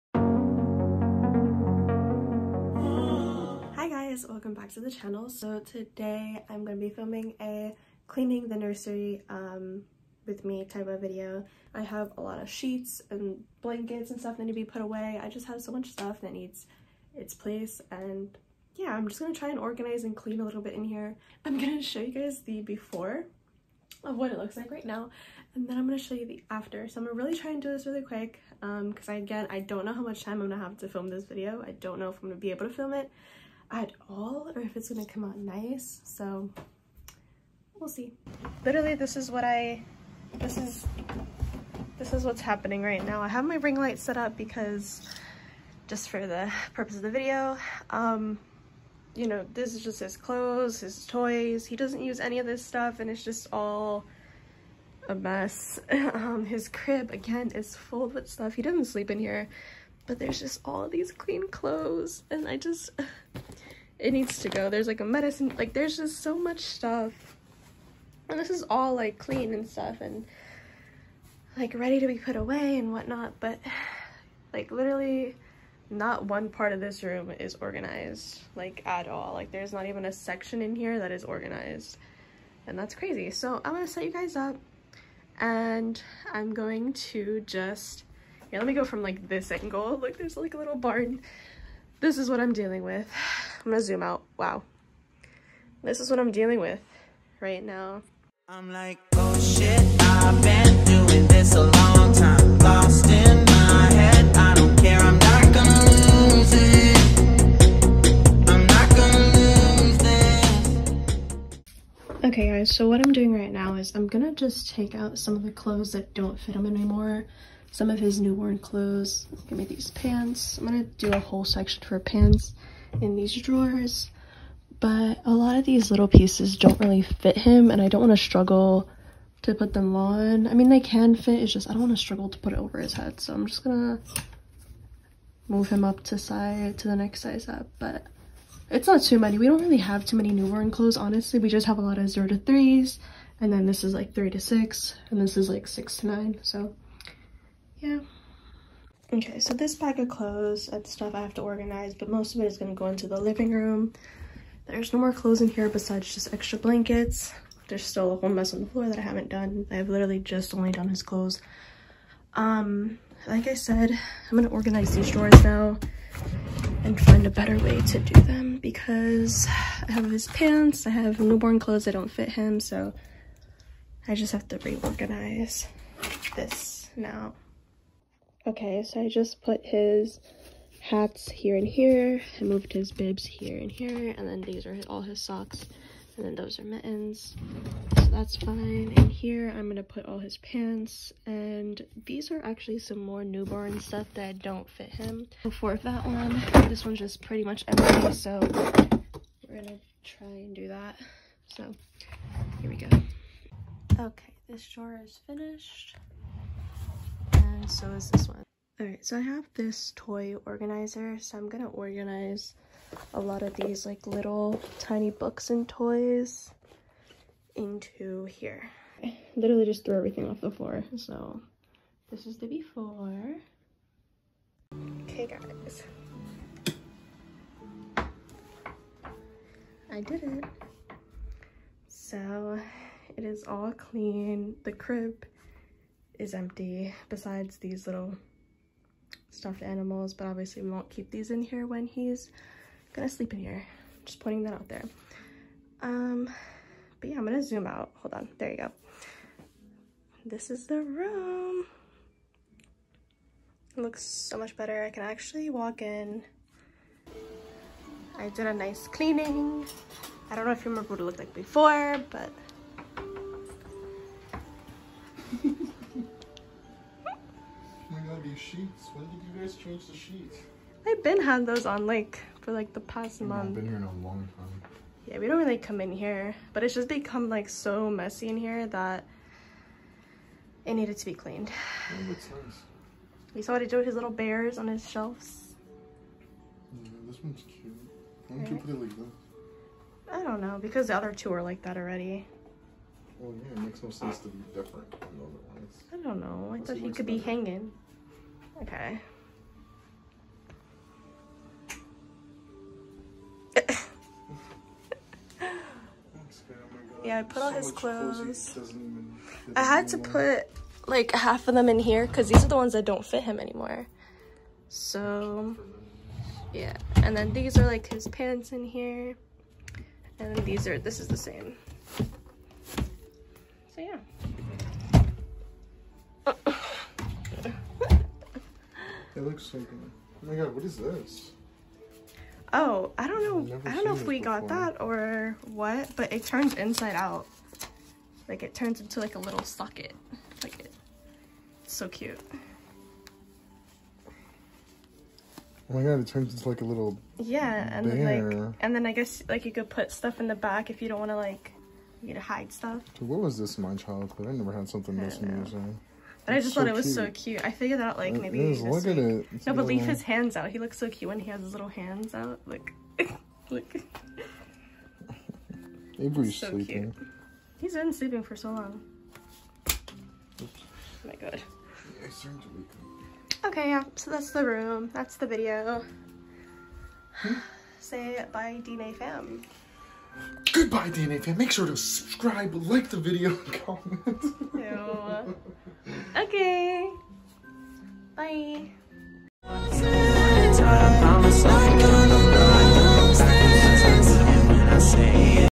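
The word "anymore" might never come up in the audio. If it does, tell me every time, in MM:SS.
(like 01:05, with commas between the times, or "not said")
01:56, 05:13.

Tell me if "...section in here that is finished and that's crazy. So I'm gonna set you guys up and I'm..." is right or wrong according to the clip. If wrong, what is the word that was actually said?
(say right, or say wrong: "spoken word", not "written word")
wrong: "organized", not "finished".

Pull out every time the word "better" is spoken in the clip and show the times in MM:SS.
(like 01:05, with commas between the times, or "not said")
02:47, 04:14, 04:57.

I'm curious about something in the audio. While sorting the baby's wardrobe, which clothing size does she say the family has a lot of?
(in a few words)
0 to 3.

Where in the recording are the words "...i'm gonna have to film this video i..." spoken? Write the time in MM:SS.
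00:30.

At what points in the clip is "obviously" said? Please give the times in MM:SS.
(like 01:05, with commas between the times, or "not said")
04:00.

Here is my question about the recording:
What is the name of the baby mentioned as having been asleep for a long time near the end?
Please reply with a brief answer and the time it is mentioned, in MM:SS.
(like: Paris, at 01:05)
Avery, at 06:05.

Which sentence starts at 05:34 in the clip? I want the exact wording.
got that or what, but it turns inside out.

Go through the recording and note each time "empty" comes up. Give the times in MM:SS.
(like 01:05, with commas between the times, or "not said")
03:17, 03:56.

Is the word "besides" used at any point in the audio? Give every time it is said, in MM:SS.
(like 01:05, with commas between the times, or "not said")
02:35, 03:57.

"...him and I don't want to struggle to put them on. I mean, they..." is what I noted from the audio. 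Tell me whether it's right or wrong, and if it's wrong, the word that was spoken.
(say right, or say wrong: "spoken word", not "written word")
right.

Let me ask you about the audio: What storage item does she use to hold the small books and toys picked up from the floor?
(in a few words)
toy organizer.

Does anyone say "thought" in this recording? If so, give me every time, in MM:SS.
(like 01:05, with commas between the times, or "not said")
04:56, 05:56.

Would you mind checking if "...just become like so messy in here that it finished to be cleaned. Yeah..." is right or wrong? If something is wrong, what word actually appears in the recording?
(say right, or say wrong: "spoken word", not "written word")
wrong: "needed", not "finished".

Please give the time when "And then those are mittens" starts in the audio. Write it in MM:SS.
03:06.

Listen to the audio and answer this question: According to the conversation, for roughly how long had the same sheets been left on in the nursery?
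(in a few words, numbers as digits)
the past month.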